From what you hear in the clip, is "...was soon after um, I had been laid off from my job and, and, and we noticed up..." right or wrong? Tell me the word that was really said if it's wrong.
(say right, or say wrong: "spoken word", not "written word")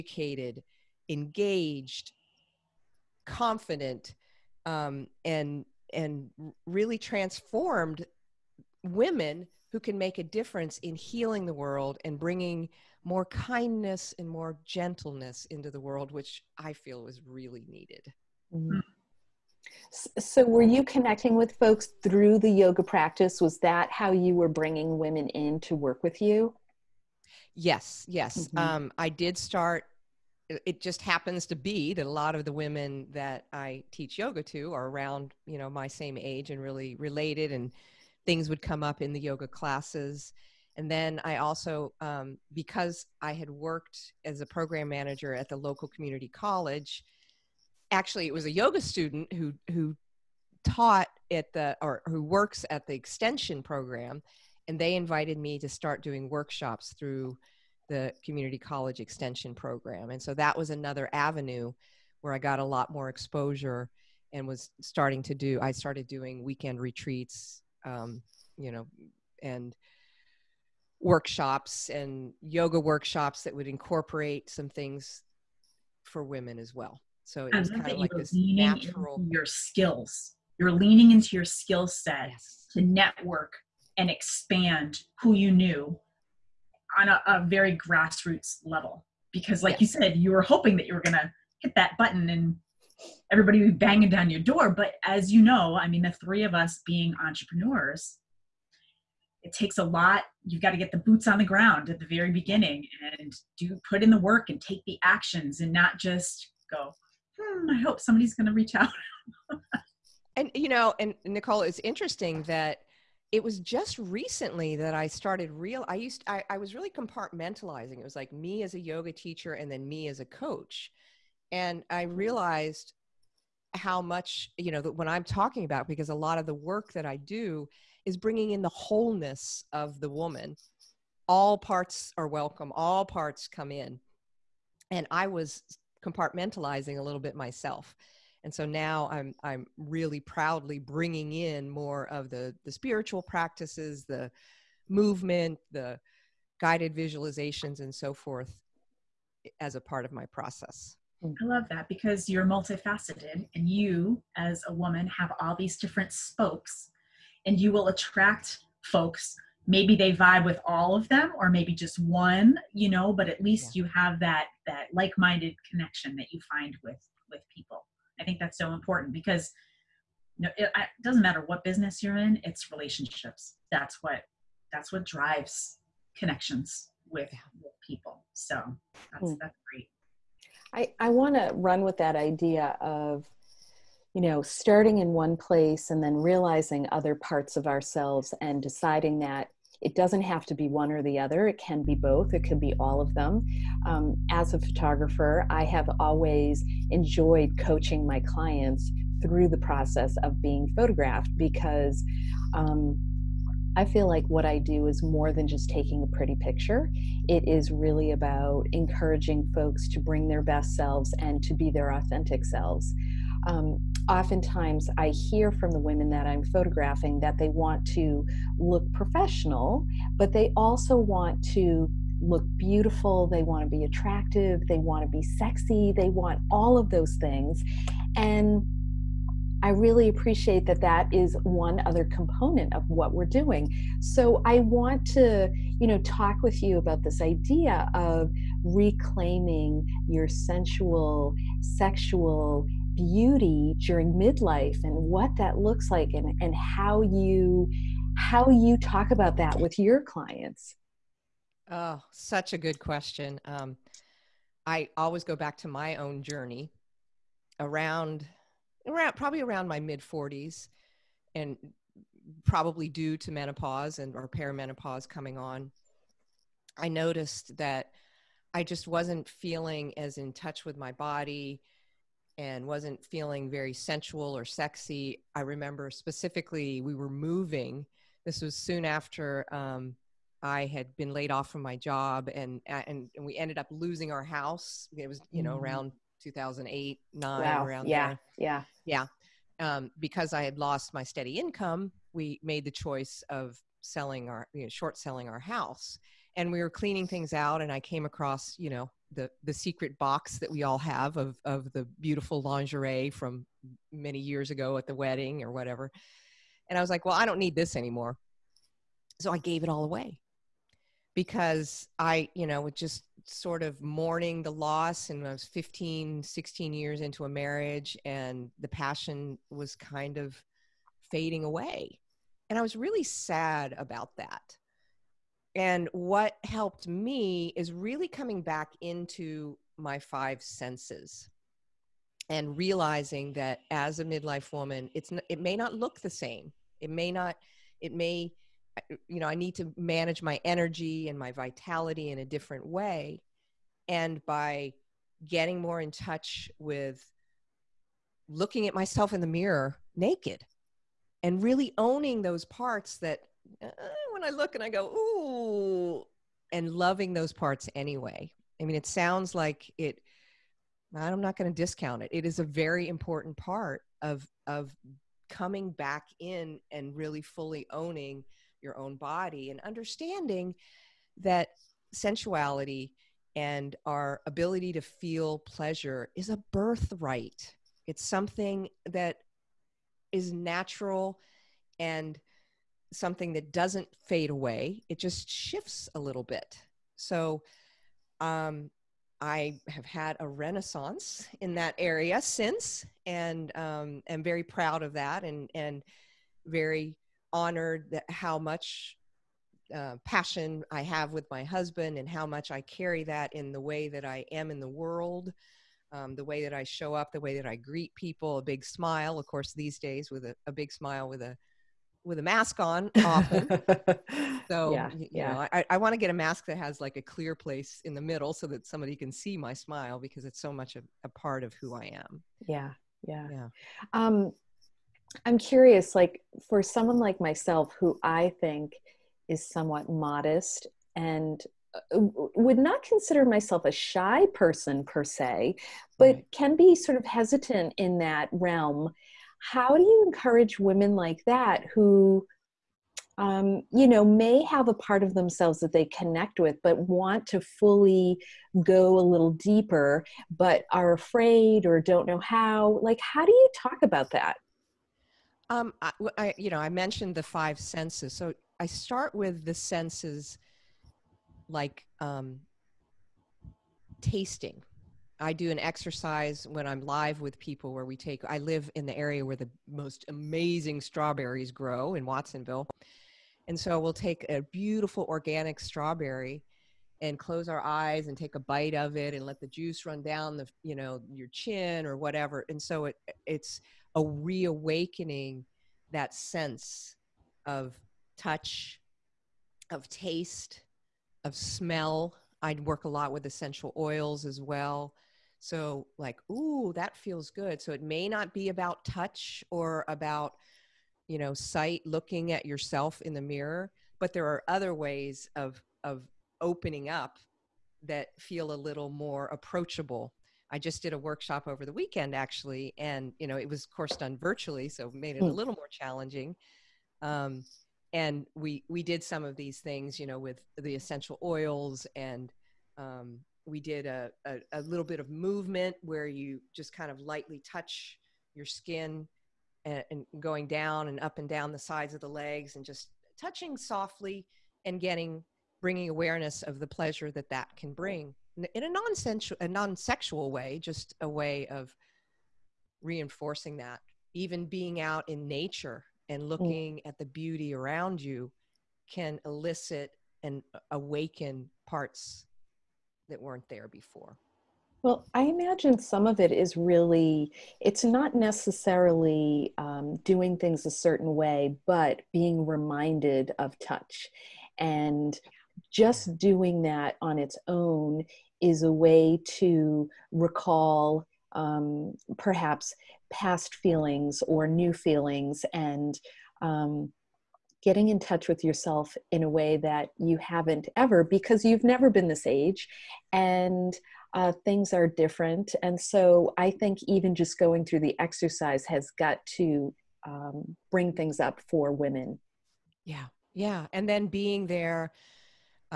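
wrong: "ended", not "noticed".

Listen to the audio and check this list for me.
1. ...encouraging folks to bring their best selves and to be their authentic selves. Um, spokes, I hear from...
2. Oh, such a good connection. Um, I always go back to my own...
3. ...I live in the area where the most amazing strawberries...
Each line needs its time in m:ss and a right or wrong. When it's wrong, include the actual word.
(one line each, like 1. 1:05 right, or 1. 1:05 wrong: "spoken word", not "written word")
1. 3:28 wrong: "oftentimes", not "spokes"
2. 4:11 wrong: "question", not "connection"
3. 7:48 right.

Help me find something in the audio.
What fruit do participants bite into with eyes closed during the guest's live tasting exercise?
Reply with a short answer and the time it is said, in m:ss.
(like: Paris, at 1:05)
strawberry, at 7:55.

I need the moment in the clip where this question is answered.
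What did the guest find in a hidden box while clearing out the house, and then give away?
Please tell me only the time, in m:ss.
5:02.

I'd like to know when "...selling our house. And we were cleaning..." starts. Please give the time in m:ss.
4:54.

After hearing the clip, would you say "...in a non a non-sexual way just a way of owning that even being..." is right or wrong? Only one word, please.
wrong.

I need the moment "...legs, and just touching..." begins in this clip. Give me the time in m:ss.
8:52.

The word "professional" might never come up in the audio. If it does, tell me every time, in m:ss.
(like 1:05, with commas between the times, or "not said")
3:38.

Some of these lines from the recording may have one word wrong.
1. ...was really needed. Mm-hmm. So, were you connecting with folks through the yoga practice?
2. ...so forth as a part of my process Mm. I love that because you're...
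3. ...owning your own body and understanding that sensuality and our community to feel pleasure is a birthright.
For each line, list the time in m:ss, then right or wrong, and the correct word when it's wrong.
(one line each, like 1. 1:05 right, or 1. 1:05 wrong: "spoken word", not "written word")
1. 0:17 right
2. 2:27 right
3. 6:07 wrong: "ability", not "community".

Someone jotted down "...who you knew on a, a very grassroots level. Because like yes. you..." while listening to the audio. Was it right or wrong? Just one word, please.
right.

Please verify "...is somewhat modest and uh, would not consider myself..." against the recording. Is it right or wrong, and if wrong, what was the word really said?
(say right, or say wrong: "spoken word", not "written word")
right.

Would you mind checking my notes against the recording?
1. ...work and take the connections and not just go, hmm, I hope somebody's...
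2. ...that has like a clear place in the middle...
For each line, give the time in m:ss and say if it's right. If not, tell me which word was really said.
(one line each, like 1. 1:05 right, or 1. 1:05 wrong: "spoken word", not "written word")
1. 1:44 wrong: "actions", not "connections"
2. 6:56 right.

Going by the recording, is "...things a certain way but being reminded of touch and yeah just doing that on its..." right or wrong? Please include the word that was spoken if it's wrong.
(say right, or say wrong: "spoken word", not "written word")
right.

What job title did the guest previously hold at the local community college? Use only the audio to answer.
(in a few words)
program manager.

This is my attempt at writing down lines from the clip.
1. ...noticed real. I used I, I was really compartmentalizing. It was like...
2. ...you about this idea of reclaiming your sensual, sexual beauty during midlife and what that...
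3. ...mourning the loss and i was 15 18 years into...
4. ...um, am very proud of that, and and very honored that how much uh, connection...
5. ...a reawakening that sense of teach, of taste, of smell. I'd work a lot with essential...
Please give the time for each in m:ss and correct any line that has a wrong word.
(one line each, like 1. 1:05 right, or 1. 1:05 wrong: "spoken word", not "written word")
1. 1:55 wrong: "started", not "noticed"
2. 3:56 right
3. 5:13 wrong: "16", not "18"
4. 6:33 wrong: "passion", not "connection"
5. 8:03 wrong: "touch", not "teach".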